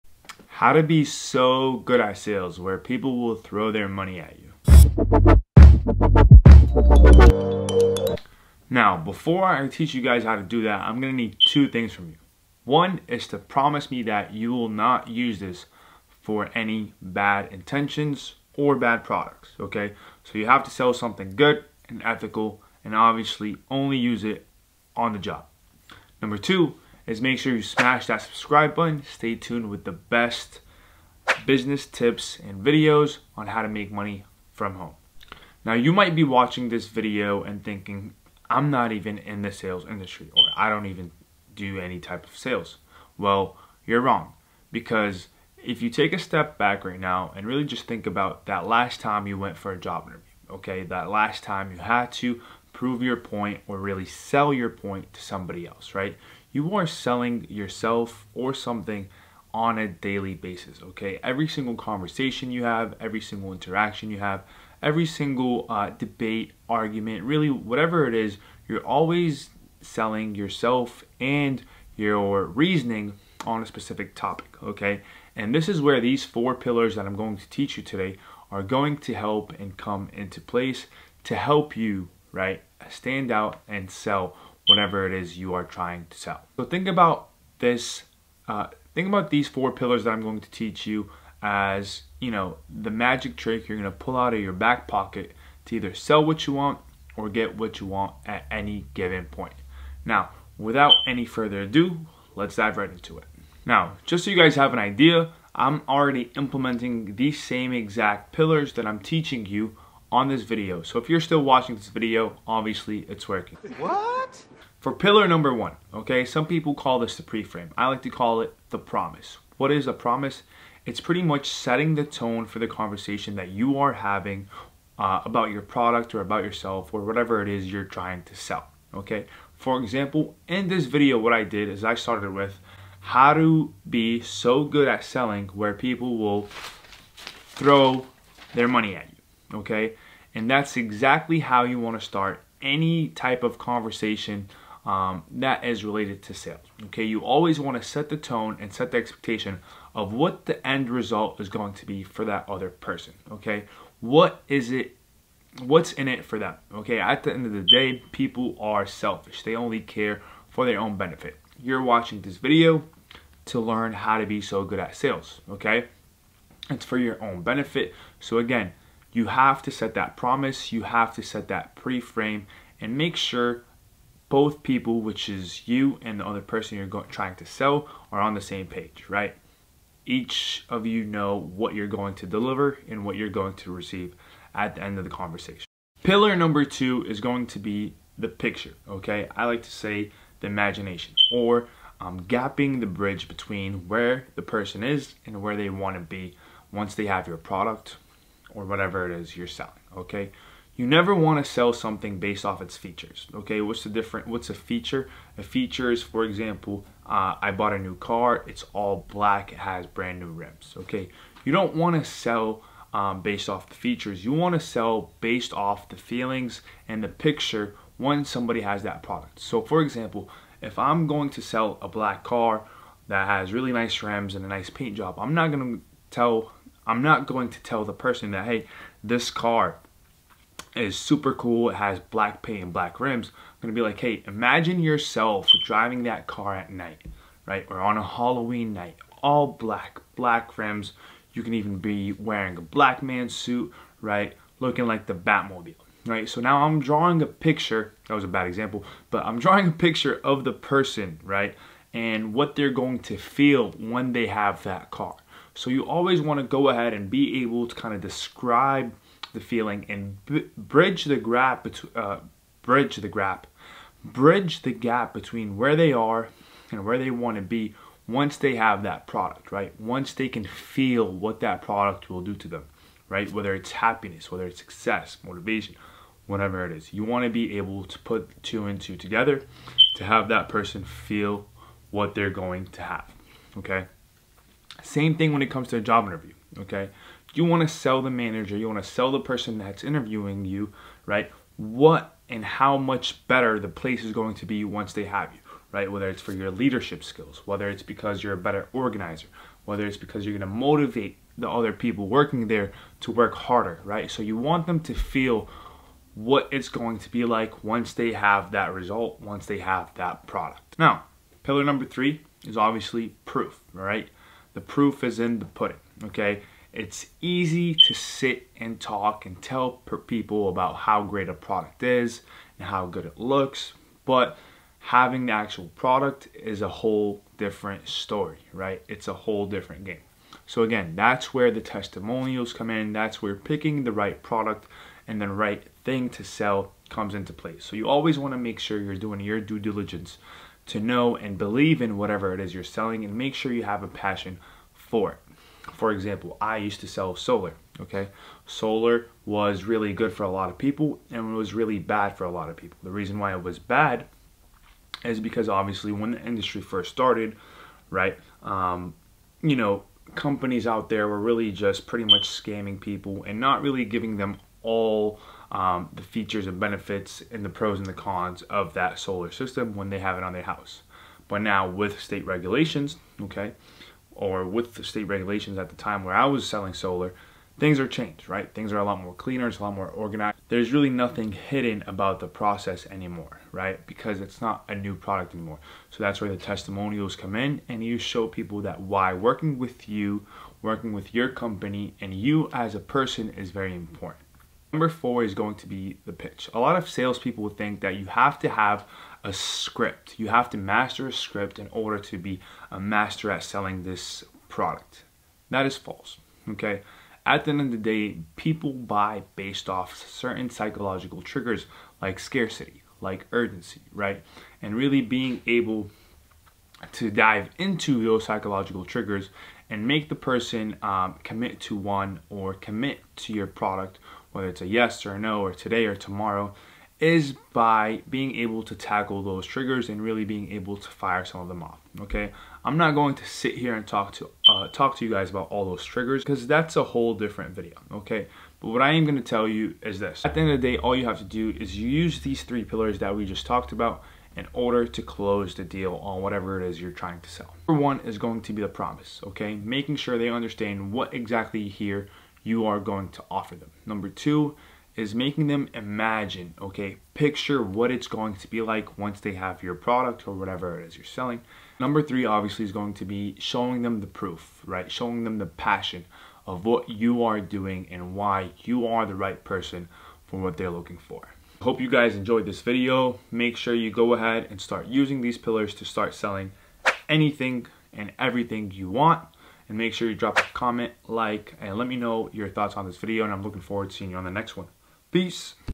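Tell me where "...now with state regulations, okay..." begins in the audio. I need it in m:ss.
6:11.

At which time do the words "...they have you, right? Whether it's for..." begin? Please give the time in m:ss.
4:54.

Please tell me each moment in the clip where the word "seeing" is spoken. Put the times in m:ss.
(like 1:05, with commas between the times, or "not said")
8:03.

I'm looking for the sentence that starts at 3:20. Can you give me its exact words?
You never want to sell something based off its features, okay?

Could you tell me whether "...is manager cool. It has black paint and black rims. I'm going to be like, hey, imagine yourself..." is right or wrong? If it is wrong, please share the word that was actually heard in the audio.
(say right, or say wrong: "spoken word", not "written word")
wrong: "super", not "manager".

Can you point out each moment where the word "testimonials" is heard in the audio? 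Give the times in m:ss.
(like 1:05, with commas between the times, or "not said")
5:31, 6:26.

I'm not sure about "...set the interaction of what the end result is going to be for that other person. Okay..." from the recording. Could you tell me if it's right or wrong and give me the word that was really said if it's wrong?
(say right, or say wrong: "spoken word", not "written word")
wrong: "expectation", not "interaction".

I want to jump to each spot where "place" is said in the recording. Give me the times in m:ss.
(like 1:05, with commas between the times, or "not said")
1:20, 4:53.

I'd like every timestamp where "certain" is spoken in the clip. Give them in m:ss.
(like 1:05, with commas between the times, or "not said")
6:50.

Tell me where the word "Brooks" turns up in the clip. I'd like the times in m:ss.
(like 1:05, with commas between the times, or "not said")
not said.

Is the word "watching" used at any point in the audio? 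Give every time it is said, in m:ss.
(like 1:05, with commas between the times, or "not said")
0:36, 1:51, 2:41.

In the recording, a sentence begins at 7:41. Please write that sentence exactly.
Number three, obviously, is going to be showing them the proof, right?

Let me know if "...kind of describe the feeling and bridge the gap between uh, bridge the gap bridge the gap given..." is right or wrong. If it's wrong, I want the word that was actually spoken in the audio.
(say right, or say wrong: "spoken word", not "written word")
wrong: "between", not "given".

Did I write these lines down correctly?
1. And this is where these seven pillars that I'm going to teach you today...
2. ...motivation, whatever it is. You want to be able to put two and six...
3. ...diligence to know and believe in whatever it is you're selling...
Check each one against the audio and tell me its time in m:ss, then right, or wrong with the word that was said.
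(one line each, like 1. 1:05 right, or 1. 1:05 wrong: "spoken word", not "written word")
1. 1:15 wrong: "four", not "seven"
2. 4:35 wrong: "two", not "six"
3. 5:39 right.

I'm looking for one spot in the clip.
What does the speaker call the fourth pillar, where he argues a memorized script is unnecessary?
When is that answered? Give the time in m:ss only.
6:36.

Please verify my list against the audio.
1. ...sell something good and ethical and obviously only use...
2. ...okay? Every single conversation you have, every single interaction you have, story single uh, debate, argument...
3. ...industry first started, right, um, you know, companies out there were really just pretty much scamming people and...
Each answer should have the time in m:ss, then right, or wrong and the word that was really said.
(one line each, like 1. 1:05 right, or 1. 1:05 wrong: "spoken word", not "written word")
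1. 0:20 right
2. 1:00 wrong: "every", not "story"
3. 5:56 right.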